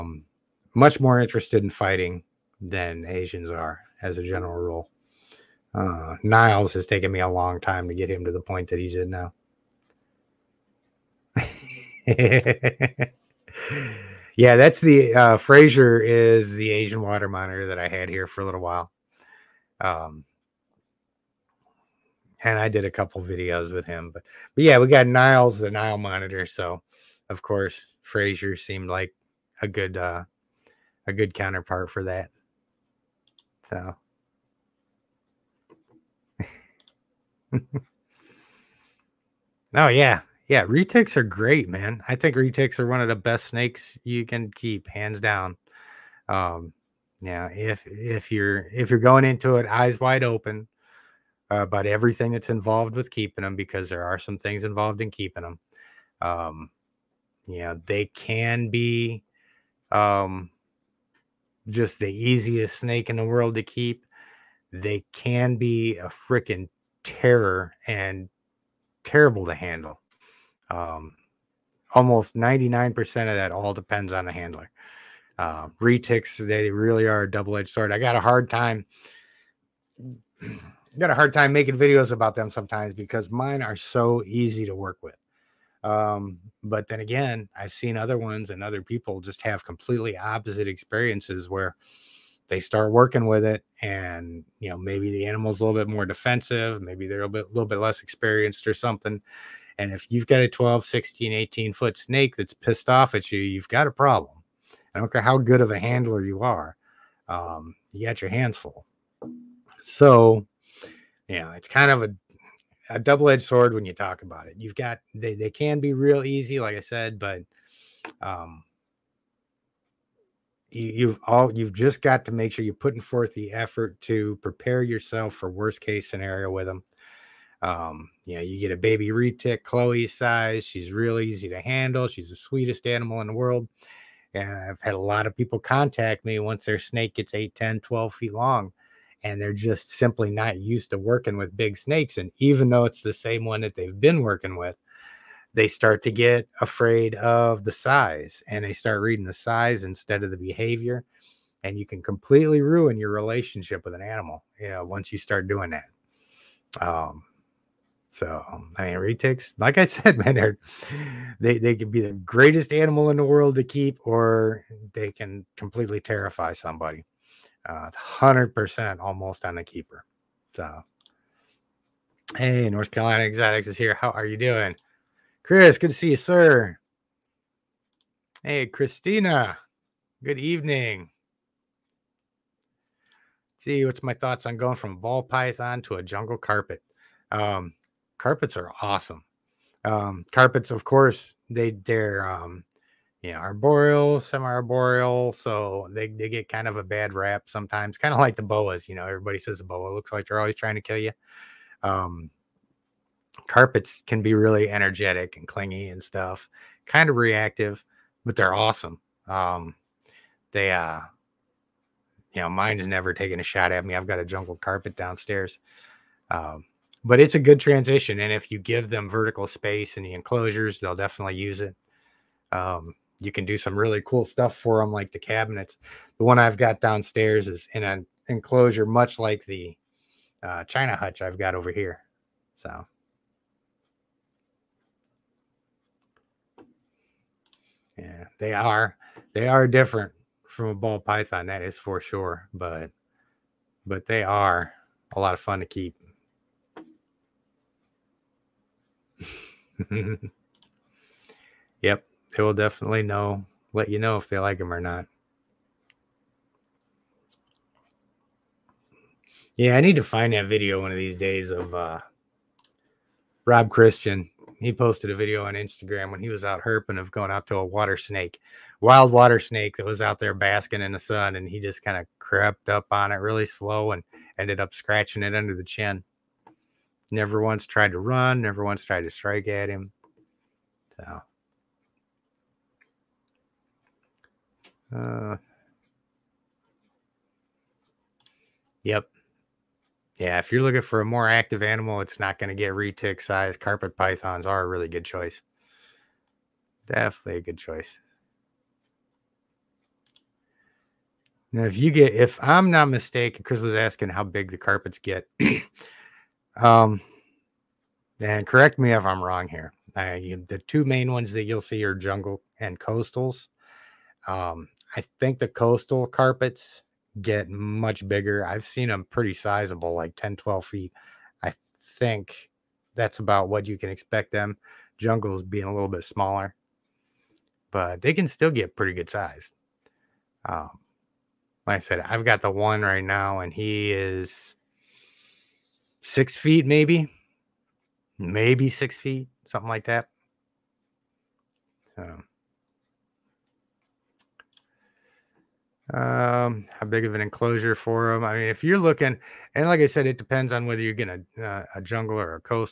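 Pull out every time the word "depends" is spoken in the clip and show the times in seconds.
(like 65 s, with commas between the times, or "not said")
73 s, 350 s.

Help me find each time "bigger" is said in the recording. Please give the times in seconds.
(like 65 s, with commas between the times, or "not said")
318 s.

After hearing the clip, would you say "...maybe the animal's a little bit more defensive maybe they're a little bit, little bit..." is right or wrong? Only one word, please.
right.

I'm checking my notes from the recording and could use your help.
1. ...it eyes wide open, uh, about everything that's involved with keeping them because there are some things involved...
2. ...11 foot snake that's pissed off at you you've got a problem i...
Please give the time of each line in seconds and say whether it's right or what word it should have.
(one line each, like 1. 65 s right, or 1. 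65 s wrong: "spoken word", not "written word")
1. 49 s right
2. 101 s wrong: "18", not "11".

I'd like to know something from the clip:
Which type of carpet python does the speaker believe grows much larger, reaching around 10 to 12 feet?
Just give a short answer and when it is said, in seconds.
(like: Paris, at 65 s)
Coastal, at 312 s.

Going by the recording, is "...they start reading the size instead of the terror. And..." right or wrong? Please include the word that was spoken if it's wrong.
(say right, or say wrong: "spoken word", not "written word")
wrong: "behavior", not "terror".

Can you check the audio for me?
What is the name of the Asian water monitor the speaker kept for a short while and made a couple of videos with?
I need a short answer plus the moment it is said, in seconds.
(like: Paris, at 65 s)
Fraser, at 15 s.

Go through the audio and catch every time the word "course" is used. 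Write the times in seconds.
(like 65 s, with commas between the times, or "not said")
27 s, 190 s.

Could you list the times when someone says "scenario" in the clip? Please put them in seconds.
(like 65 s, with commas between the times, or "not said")
126 s.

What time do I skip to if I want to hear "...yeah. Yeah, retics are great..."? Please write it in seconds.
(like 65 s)
39 s.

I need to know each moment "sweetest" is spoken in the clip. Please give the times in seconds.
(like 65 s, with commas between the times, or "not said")
132 s.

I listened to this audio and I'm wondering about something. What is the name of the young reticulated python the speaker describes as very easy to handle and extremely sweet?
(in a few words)
Chloe.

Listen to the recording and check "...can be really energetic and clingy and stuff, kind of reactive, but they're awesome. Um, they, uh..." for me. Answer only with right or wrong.
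right.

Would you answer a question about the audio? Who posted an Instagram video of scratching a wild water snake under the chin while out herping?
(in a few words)
Rob Christian.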